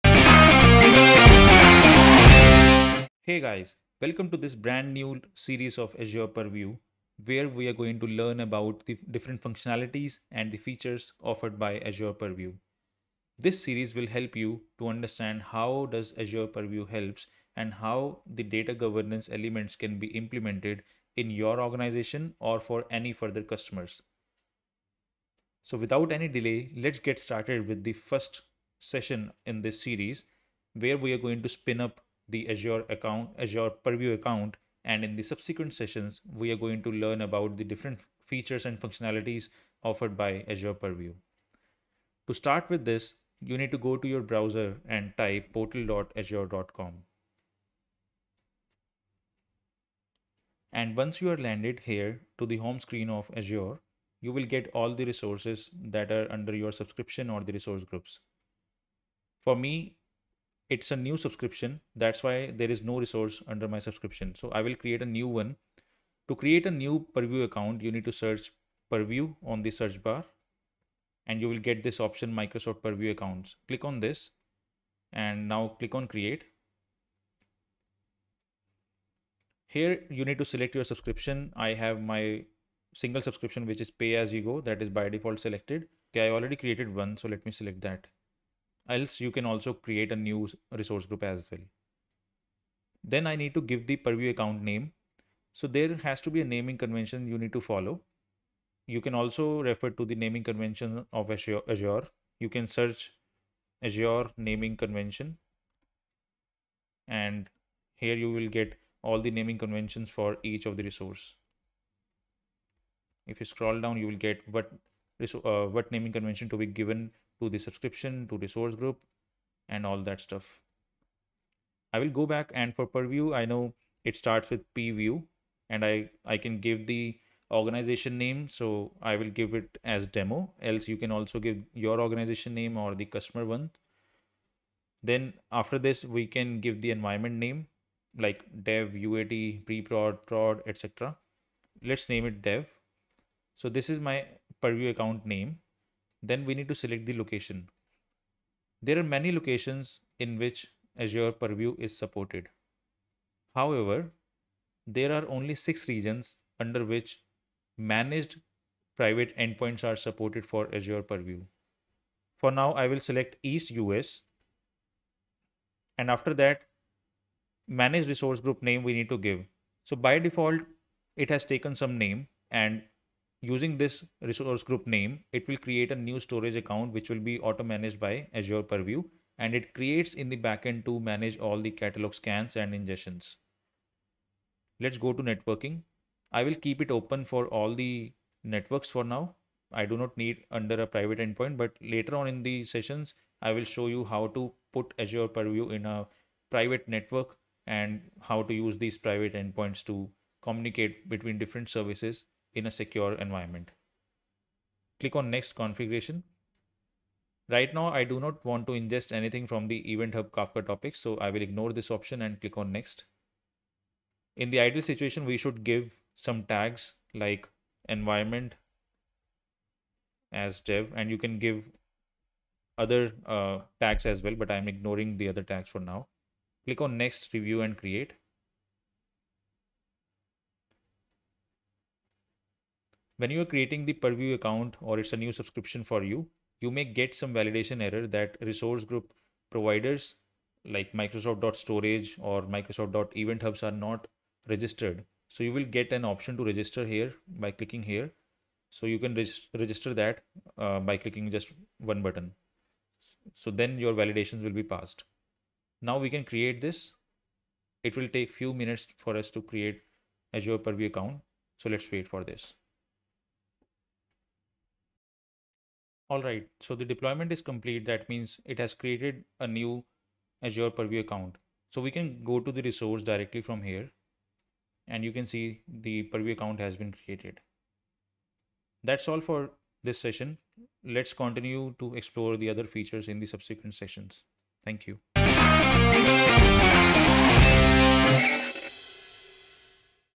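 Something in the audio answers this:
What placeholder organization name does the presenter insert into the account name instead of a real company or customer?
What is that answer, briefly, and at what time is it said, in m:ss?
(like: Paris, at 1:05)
demo, at 2:10.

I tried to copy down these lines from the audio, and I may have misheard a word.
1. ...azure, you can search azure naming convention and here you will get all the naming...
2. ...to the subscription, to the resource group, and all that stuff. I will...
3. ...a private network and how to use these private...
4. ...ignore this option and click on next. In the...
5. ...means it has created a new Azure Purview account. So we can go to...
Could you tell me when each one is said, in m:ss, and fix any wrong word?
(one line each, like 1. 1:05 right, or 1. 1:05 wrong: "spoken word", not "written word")
1. 1:41 right
2. 1:57 wrong: "source", not "resource"
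3. 3:15 right
4. 3:31 right
5. 4:28 right.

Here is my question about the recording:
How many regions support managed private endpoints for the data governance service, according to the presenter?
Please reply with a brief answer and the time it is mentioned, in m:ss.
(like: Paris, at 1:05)
6, at 2:35.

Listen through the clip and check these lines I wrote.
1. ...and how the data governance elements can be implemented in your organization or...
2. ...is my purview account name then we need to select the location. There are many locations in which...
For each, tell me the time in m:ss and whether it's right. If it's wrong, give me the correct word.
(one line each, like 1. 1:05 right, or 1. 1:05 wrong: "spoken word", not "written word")
1. 0:17 right
2. 2:23 right.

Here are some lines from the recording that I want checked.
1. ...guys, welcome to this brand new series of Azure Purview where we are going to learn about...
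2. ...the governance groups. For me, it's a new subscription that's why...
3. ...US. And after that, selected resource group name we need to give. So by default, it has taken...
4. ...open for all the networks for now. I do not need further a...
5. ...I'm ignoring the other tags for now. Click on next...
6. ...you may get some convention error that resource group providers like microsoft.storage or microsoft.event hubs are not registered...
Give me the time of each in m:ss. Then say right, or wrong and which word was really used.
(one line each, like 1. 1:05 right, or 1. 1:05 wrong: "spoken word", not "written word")
1. 0:03 right
2. 0:57 wrong: "resource", not "governance"
3. 2:43 wrong: "managed", not "selected"
4. 3:06 wrong: "under", not "further"
5. 3:44 right
6. 3:56 wrong: "validation", not "convention".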